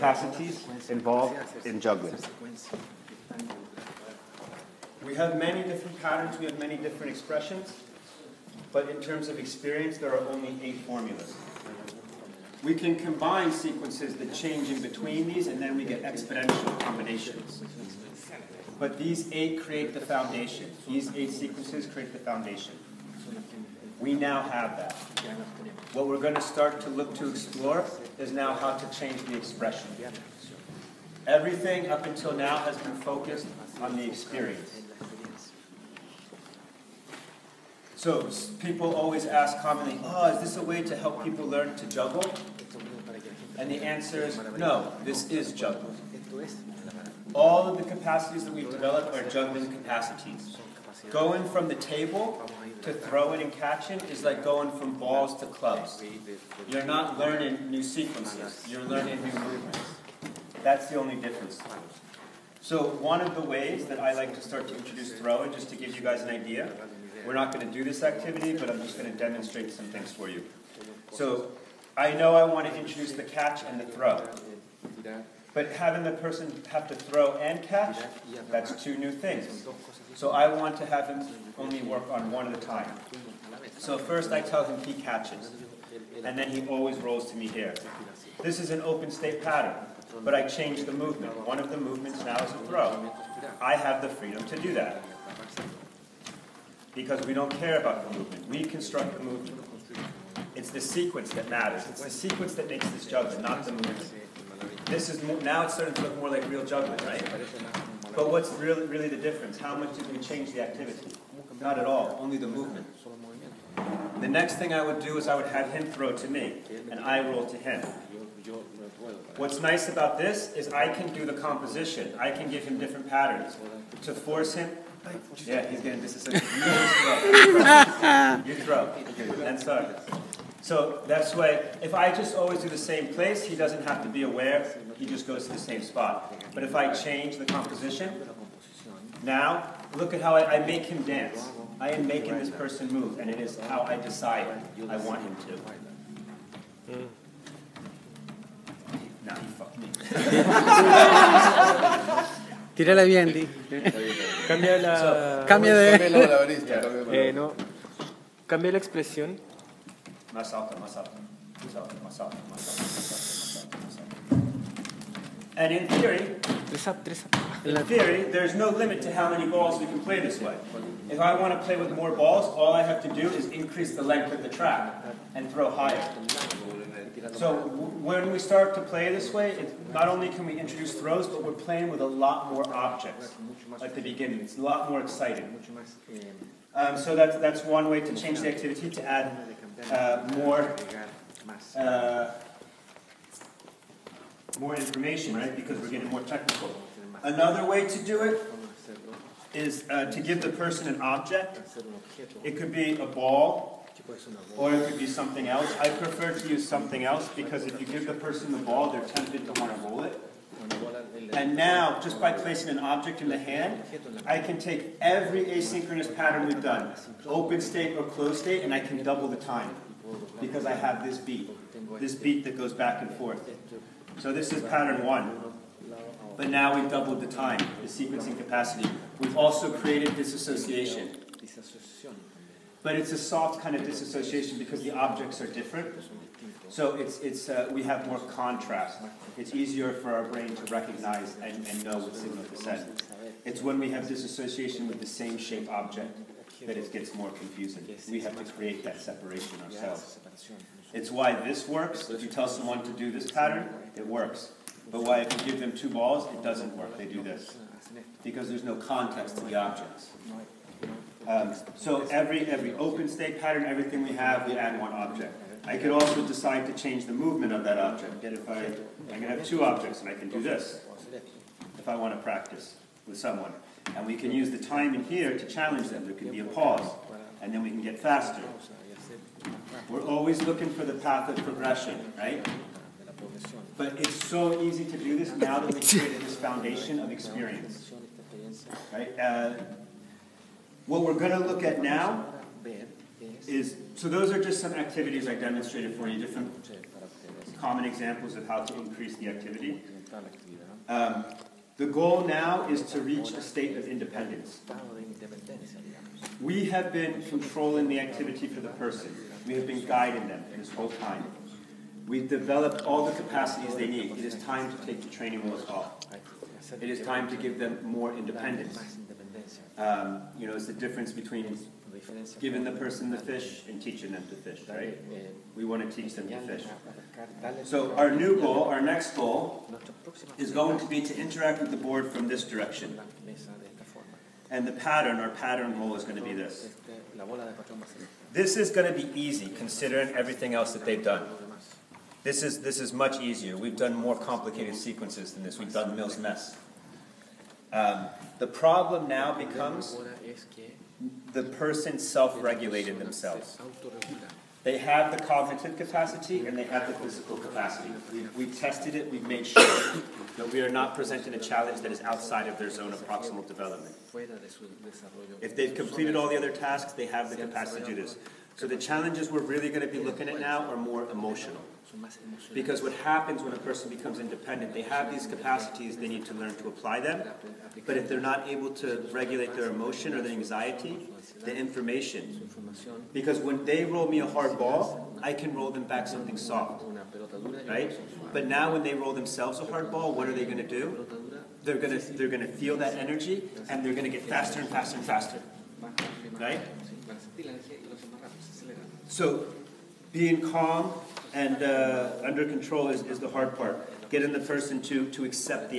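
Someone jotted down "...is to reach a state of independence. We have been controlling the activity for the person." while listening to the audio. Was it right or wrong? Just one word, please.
right.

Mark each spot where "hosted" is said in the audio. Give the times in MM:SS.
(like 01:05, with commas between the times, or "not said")
not said.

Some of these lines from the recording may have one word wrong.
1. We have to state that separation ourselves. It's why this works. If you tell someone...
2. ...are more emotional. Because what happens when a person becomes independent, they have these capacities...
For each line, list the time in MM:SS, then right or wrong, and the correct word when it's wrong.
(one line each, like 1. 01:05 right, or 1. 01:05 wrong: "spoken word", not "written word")
1. 04:08 wrong: "create", not "state"
2. 06:10 right.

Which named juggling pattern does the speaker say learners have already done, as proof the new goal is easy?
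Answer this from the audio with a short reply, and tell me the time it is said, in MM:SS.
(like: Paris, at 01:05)
Mills Mess, at 05:45.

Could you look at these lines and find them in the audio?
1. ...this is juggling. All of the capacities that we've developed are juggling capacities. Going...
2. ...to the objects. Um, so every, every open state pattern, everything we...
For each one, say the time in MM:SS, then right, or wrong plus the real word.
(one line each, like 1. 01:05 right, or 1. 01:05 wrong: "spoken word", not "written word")
1. 00:45 right
2. 04:19 right.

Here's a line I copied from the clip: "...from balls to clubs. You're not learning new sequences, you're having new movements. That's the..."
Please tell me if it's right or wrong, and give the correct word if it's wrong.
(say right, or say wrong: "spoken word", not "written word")
wrong: "learning", not "having".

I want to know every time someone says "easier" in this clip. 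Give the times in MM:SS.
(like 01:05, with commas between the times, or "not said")
03:59, 05:43.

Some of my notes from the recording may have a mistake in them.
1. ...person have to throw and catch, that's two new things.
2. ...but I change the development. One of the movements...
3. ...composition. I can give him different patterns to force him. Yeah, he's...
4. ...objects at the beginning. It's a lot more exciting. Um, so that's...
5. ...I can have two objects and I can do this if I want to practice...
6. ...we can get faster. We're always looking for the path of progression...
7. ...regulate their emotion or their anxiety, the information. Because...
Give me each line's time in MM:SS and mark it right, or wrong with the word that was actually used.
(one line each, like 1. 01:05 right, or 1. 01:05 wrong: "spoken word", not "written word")
1. 01:16 right
2. 01:30 wrong: "movement", not "development"
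3. 02:01 right
4. 03:02 right
5. 04:29 right
6. 04:37 right
7. 06:19 right.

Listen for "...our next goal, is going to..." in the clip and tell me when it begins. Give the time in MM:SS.
05:28.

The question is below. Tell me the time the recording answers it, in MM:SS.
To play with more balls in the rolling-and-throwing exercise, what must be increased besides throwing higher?
02:54.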